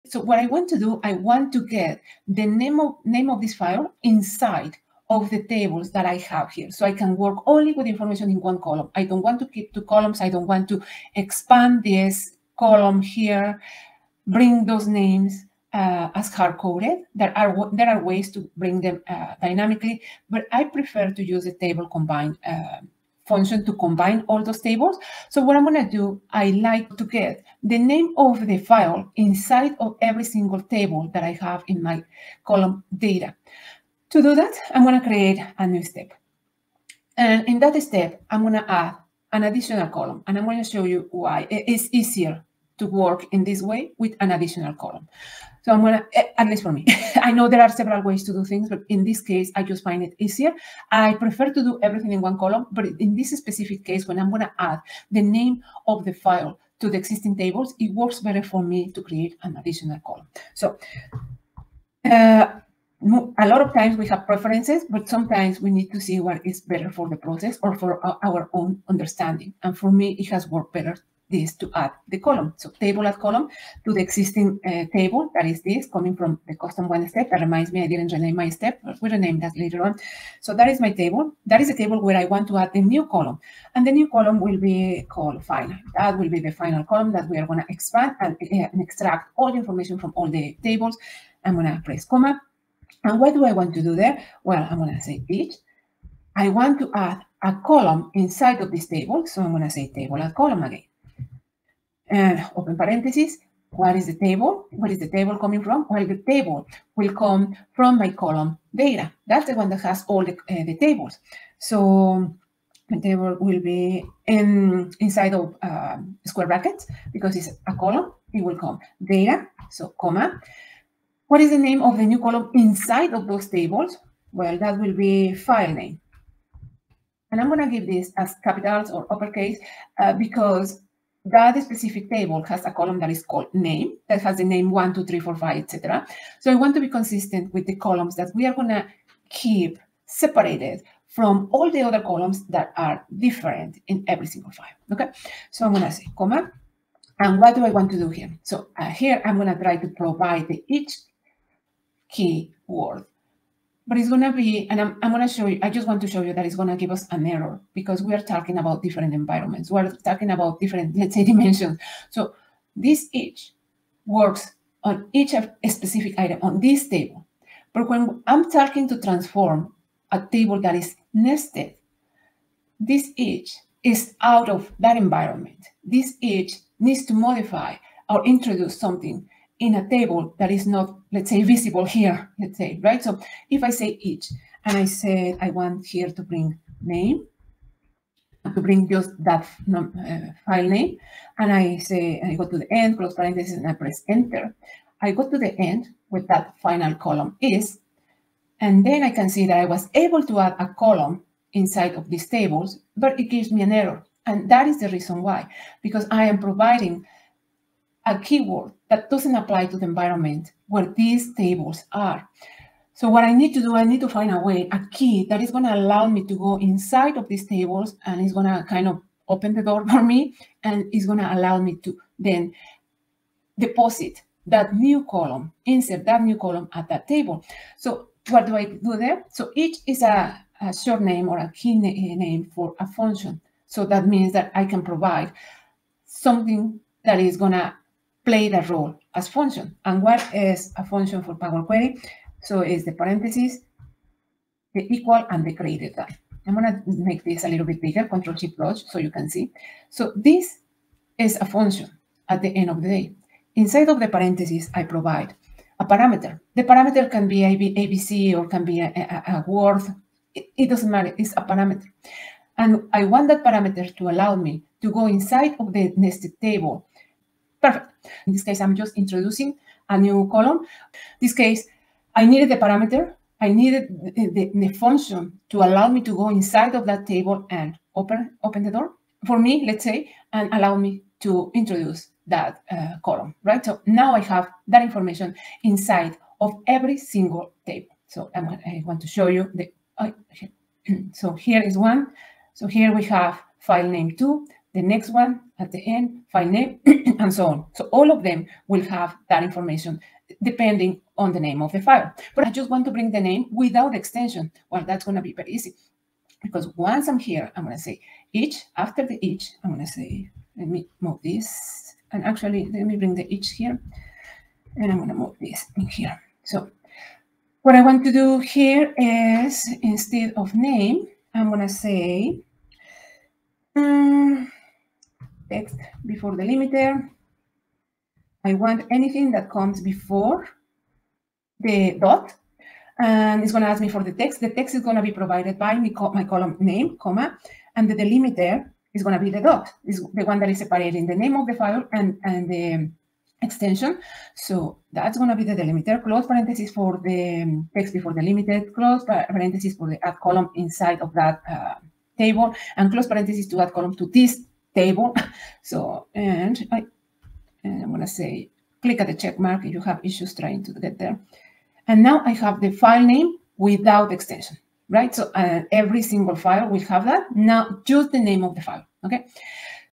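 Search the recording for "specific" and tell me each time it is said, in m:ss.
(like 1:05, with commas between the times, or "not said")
0:53, 2:11, 2:45.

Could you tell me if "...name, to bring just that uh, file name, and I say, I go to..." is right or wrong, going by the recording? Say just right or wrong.
right.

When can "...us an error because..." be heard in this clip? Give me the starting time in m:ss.
2:36.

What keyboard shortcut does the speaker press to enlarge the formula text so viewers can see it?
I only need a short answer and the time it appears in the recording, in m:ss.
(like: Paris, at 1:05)
Control Shift Plus, at 4:08.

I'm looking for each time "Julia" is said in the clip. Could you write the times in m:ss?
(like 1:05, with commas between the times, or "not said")
not said.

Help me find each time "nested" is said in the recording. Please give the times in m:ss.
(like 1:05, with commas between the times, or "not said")
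2:51, 4:25.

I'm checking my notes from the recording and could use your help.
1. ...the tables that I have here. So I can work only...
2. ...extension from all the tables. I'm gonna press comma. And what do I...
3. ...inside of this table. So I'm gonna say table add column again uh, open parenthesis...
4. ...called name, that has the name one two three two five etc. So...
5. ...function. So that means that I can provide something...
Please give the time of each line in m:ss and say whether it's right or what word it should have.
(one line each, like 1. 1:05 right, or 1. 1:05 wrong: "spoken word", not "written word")
1. 0:05 right
2. 1:29 wrong: "information", not "extension"
3. 1:38 right
4. 2:13 wrong: "four", not "two"
5. 3:52 right.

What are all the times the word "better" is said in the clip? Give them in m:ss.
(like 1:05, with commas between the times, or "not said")
0:58, 1:06, 1:10.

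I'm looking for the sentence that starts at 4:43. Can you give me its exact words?
So now I have that information inside of every single table.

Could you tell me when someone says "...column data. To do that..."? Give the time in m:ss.
0:32.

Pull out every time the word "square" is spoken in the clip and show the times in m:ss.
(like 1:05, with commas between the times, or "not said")
1:56.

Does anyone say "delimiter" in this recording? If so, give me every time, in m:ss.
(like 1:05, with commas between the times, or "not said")
5:26, 5:38, 5:45.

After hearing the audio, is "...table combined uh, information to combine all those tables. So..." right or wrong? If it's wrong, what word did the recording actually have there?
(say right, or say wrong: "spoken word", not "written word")
wrong: "function", not "information".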